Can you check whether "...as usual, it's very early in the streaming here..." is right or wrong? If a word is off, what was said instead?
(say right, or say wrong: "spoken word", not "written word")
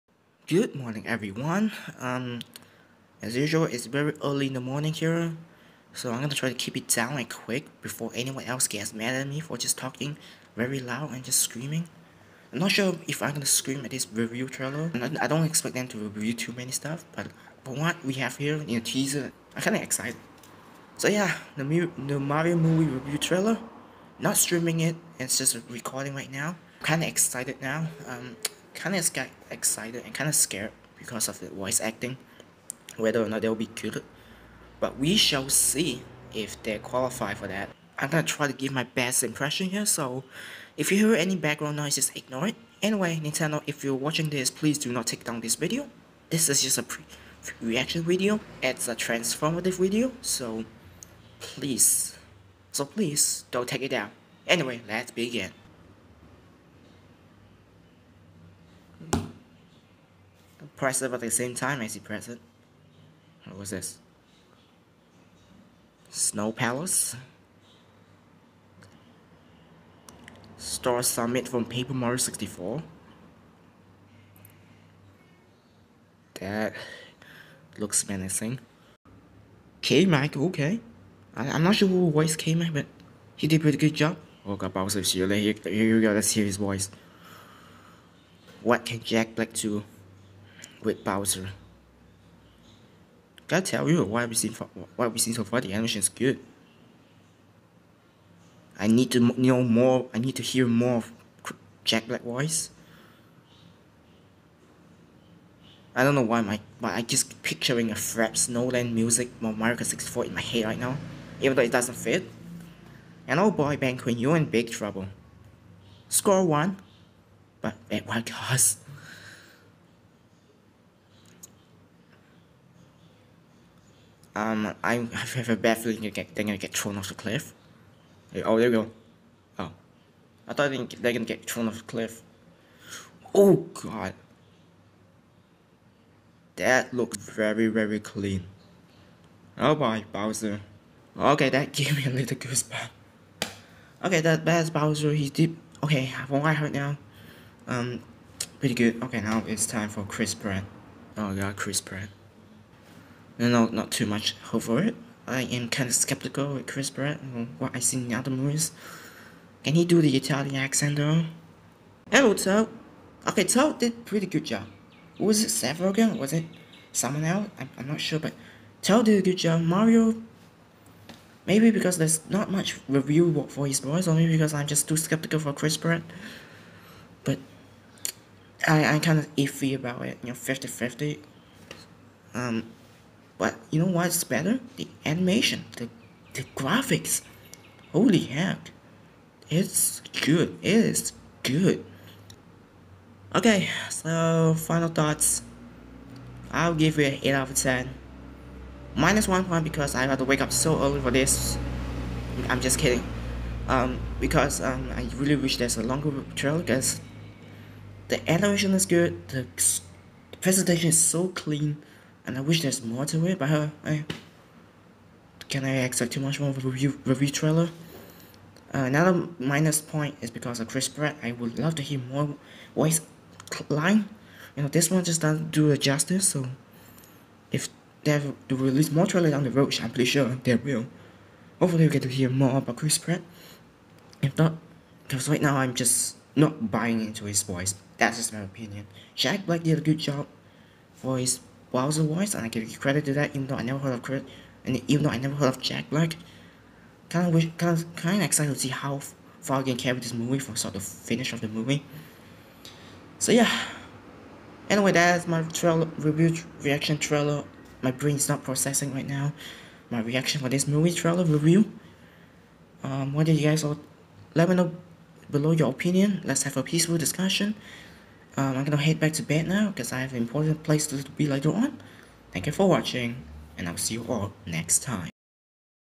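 wrong: "morning", not "streaming".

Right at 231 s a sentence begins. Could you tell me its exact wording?
Hopefully we get to hear more about Chris Pratt.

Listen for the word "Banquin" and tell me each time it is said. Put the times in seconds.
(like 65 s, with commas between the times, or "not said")
113 s.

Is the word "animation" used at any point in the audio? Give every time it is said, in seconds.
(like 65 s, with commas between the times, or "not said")
95 s, 185 s, 208 s.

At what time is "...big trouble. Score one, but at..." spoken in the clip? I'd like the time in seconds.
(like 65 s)
114 s.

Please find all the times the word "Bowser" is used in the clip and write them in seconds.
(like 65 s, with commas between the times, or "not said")
84 s, 91 s, 140 s, 144 s, 241 s.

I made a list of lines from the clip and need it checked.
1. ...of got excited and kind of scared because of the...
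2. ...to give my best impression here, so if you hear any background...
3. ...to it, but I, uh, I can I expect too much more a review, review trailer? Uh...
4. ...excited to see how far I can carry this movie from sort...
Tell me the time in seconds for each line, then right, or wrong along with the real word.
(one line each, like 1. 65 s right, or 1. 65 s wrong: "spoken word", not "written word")
1. 28 s right
2. 38 s right
3. 213 s right
4. 248 s right.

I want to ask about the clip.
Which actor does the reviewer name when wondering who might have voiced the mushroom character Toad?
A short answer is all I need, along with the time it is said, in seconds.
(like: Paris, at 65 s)
Seth Rogen, at 165 s.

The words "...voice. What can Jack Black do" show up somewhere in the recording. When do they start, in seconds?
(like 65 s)
86 s.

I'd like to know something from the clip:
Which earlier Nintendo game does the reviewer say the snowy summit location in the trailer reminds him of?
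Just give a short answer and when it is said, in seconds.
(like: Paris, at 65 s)
Paper Mario 64, at 71 s.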